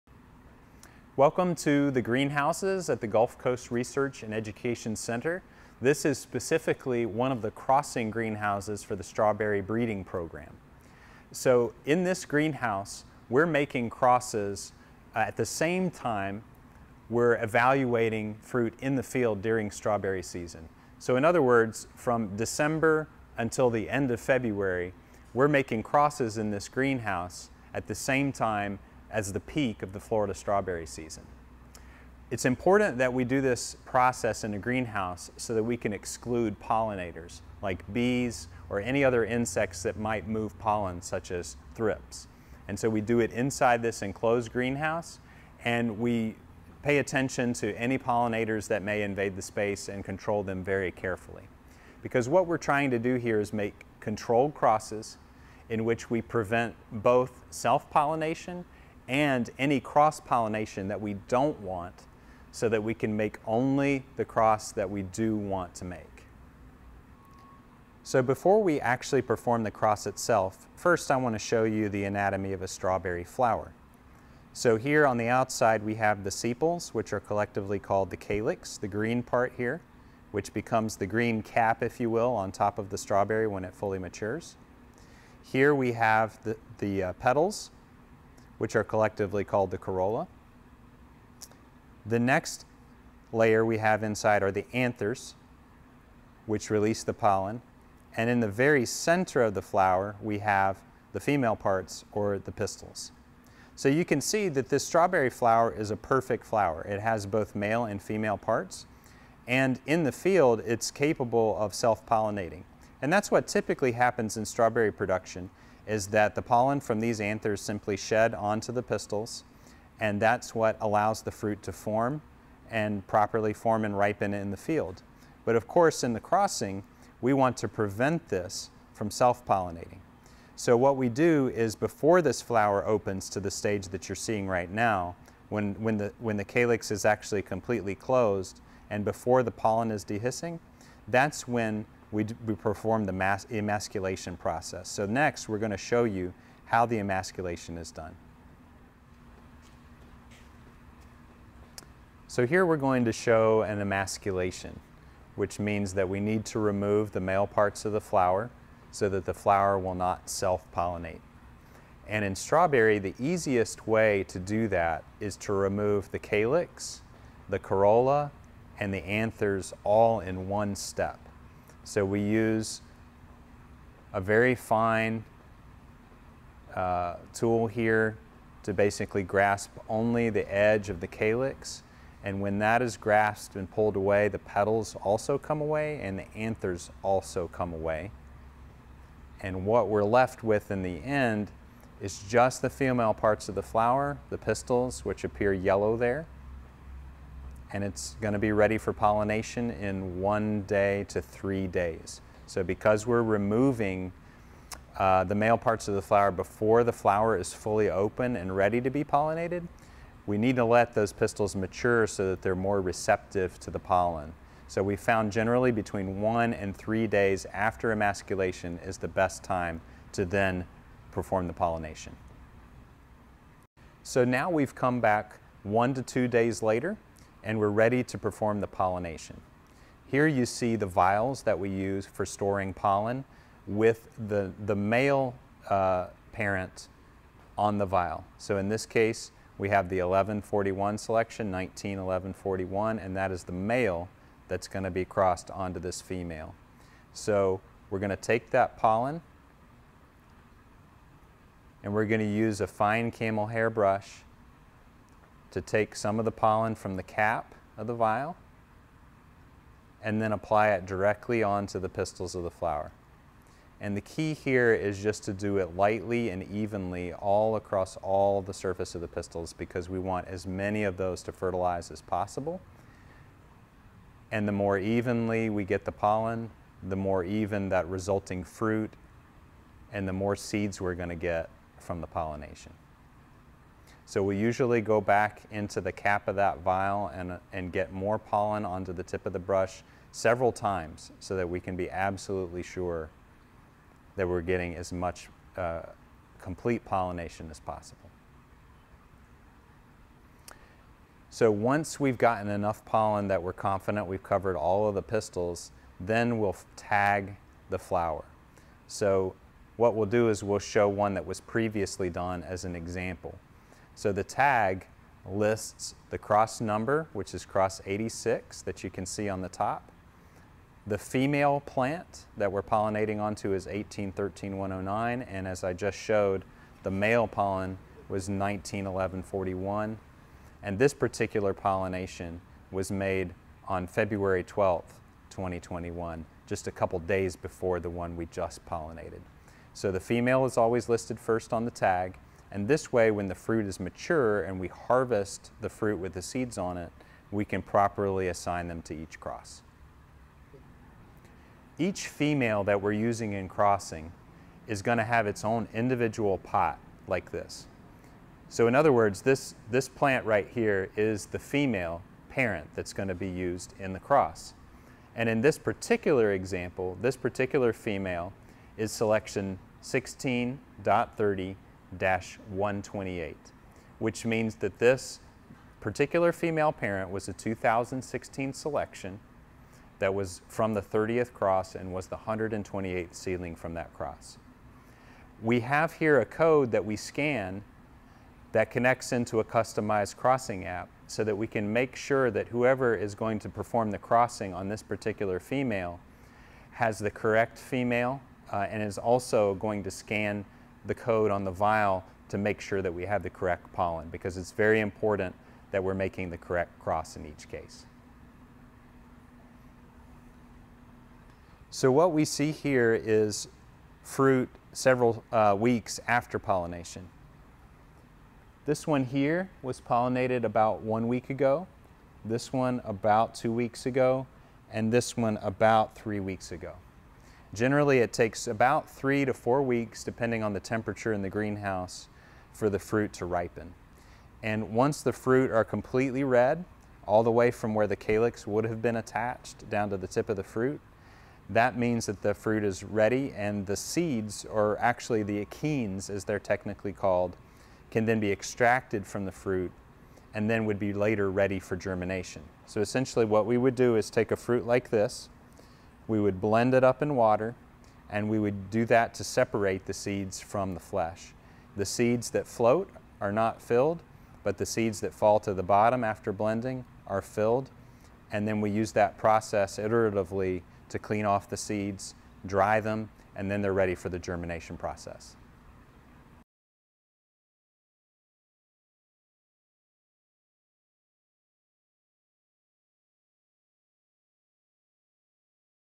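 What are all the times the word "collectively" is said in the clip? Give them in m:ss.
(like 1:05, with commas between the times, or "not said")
1:17, 1:28.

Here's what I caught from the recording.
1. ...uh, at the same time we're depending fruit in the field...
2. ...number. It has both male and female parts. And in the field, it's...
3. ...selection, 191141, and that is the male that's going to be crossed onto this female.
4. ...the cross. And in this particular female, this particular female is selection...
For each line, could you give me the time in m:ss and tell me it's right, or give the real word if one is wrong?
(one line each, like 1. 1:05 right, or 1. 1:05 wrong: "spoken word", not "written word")
1. 0:15 wrong: "evaluating", not "depending"
2. 1:46 wrong: "flower", not "number"
3. 4:00 right
4. 6:03 wrong: "example", not "female".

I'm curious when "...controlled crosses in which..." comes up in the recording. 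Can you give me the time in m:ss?
0:53.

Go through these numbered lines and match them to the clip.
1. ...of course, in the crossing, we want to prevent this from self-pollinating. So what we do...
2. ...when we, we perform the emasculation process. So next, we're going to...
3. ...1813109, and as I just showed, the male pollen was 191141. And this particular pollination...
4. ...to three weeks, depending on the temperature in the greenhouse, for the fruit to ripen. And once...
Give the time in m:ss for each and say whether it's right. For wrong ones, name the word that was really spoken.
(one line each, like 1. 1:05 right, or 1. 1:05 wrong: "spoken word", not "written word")
1. 2:05 right
2. 2:21 right
3. 5:23 right
4. 7:09 wrong: "four", not "three".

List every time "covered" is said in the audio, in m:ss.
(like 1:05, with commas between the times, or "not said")
5:04.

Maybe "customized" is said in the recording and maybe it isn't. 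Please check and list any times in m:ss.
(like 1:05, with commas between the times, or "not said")
6:29.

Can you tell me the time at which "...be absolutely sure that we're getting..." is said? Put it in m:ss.
4:51.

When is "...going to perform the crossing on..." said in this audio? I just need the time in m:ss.
6:33.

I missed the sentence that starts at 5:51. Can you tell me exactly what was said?
Each female that we're using in crossing is going to have its own individual pot like this.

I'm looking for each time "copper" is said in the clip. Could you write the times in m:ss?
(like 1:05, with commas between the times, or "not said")
not said.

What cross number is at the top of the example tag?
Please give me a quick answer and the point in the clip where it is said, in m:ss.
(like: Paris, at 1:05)
86, at 5:17.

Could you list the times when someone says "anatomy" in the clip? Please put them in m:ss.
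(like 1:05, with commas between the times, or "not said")
1:12.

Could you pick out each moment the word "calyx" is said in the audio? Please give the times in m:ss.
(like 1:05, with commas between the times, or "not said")
1:18, 2:16, 2:46, 3:01, 7:17.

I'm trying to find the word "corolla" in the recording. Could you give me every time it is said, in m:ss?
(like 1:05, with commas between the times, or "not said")
1:29, 2:47.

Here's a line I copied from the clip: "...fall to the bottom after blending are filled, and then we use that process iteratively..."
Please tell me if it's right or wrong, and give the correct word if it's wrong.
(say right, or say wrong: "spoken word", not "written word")
right.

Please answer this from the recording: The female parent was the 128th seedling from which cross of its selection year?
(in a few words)
30th.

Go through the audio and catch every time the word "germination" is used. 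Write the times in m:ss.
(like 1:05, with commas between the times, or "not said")
7:31, 7:54.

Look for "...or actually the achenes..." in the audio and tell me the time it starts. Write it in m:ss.
7:24.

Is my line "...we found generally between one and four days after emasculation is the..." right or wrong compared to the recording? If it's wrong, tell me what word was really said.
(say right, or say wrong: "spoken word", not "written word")
wrong: "three", not "four".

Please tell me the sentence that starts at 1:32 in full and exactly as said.
The next layer we have inside are the anthers, which release the pollen.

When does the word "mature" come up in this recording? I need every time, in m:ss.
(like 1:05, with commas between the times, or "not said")
1:23, 3:31, 5:43.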